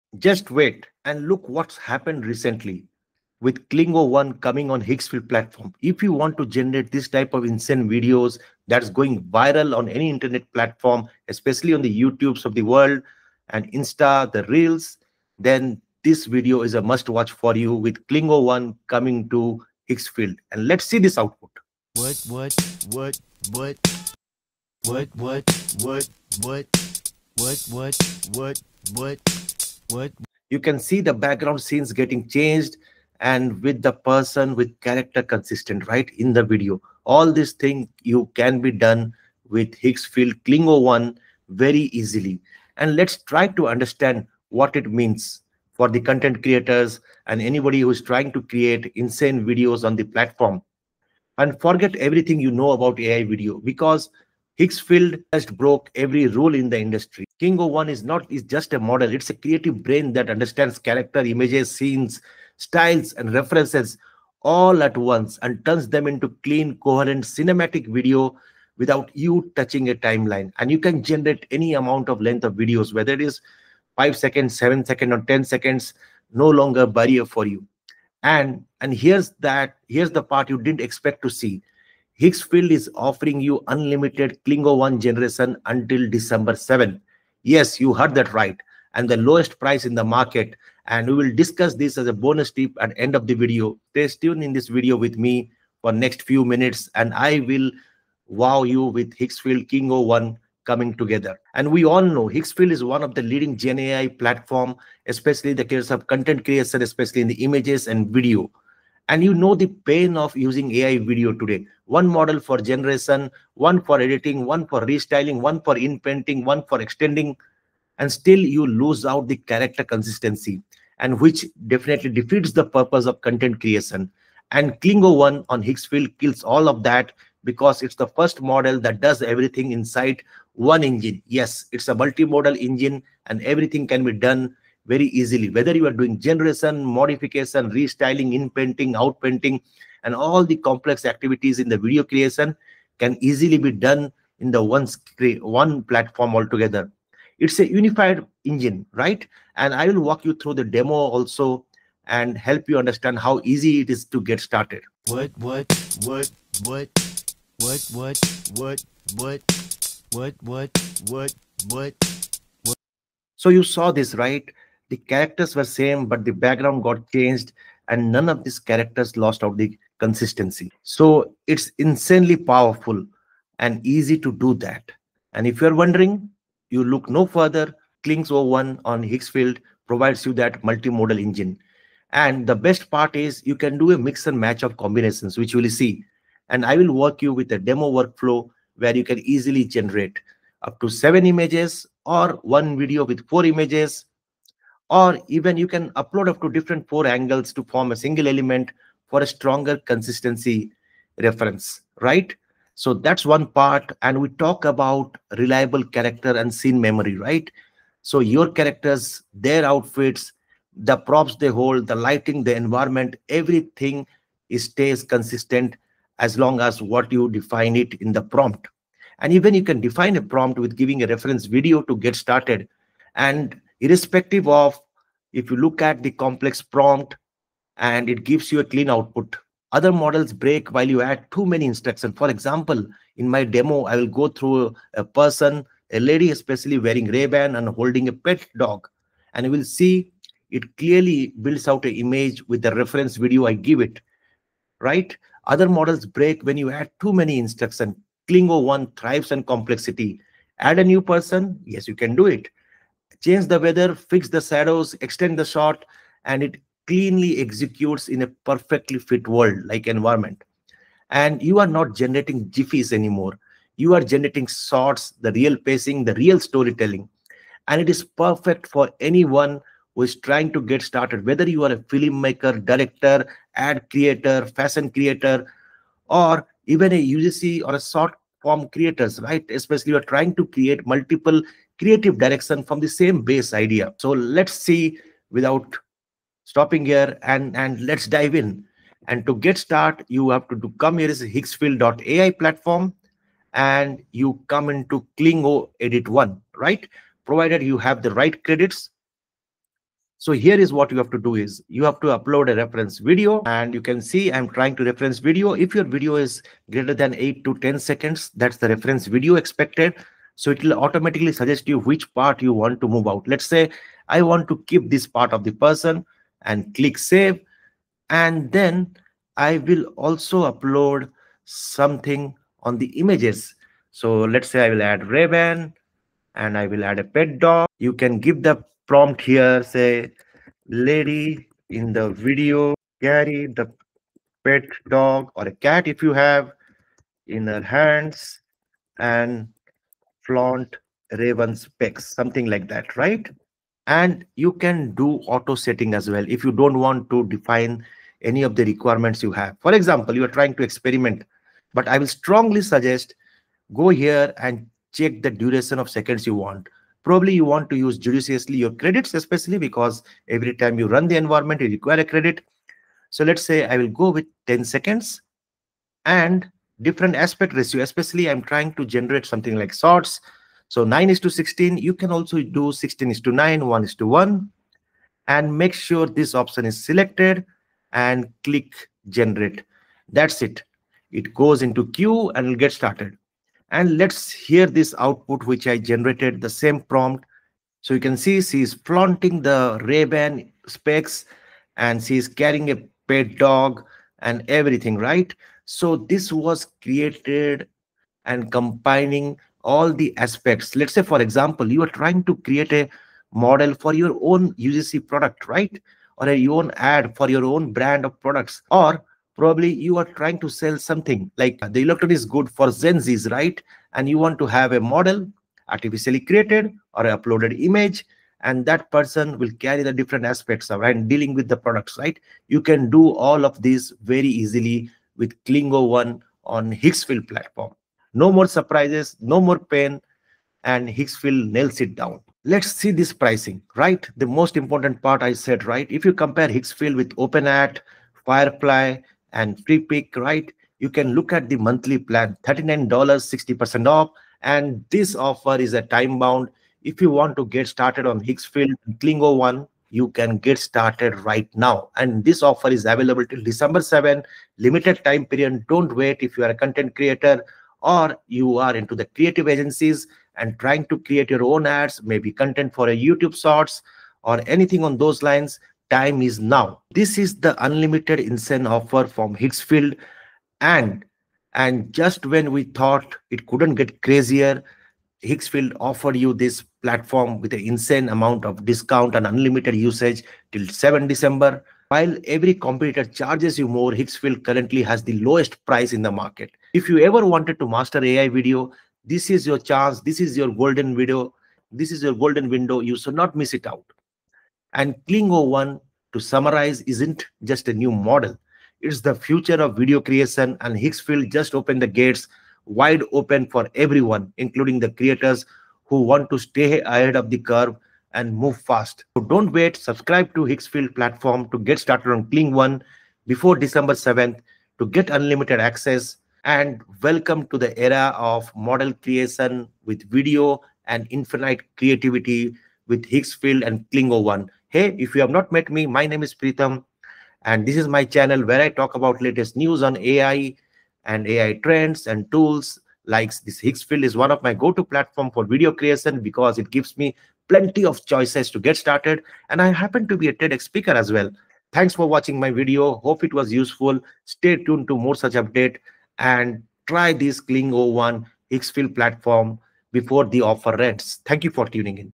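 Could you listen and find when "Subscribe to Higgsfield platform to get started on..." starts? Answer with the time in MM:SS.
08:29.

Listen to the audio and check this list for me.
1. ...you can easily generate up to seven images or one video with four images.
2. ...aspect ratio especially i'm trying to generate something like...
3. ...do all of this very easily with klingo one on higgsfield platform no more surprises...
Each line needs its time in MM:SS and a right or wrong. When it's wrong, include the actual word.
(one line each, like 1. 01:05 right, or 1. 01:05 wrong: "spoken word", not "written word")
1. 03:08 right
2. 06:07 right
3. 07:02 right.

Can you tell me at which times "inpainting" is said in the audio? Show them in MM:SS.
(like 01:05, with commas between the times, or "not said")
01:55, 02:18.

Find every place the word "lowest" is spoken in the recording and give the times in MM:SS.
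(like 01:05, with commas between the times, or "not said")
01:29, 08:05.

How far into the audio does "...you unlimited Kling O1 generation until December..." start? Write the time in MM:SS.
01:23.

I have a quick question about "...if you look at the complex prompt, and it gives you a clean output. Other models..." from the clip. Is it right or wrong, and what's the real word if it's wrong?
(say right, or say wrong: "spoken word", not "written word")
right.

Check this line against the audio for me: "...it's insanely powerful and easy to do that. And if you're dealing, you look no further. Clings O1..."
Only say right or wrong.
wrong.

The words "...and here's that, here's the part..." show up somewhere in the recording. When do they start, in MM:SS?
01:18.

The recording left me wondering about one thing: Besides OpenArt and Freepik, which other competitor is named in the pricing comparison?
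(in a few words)
Firefly.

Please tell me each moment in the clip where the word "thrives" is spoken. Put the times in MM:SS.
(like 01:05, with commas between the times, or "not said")
04:08.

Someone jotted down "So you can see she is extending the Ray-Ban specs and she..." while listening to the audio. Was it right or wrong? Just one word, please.
wrong.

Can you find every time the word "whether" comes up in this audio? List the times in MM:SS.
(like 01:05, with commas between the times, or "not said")
01:12, 02:15, 04:31.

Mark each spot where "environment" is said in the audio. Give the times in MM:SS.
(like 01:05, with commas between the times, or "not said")
03:32, 04:19, 06:01.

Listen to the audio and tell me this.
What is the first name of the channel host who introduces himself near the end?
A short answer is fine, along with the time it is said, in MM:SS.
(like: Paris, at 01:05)
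Pritam, at 08:46.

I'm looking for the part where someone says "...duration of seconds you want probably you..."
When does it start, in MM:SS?
05:55.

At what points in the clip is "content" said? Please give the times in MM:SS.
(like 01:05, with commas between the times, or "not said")
00:46, 01:46, 02:03, 07:36, 07:42.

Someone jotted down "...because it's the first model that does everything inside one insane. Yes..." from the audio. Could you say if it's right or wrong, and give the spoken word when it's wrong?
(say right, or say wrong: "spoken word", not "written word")
wrong: "engine", not "insane".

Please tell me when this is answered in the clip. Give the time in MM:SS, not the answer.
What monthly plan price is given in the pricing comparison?
07:22.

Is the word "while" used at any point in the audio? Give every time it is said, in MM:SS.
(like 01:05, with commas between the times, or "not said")
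03:50, 08:01.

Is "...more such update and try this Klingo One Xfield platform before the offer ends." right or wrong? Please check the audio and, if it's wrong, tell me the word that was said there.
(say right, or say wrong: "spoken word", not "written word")
right.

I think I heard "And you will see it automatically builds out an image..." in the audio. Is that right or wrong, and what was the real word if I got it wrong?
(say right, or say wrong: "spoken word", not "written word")
wrong: "clearly", not "automatically".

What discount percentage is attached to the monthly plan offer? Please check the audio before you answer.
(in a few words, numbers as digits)
60%.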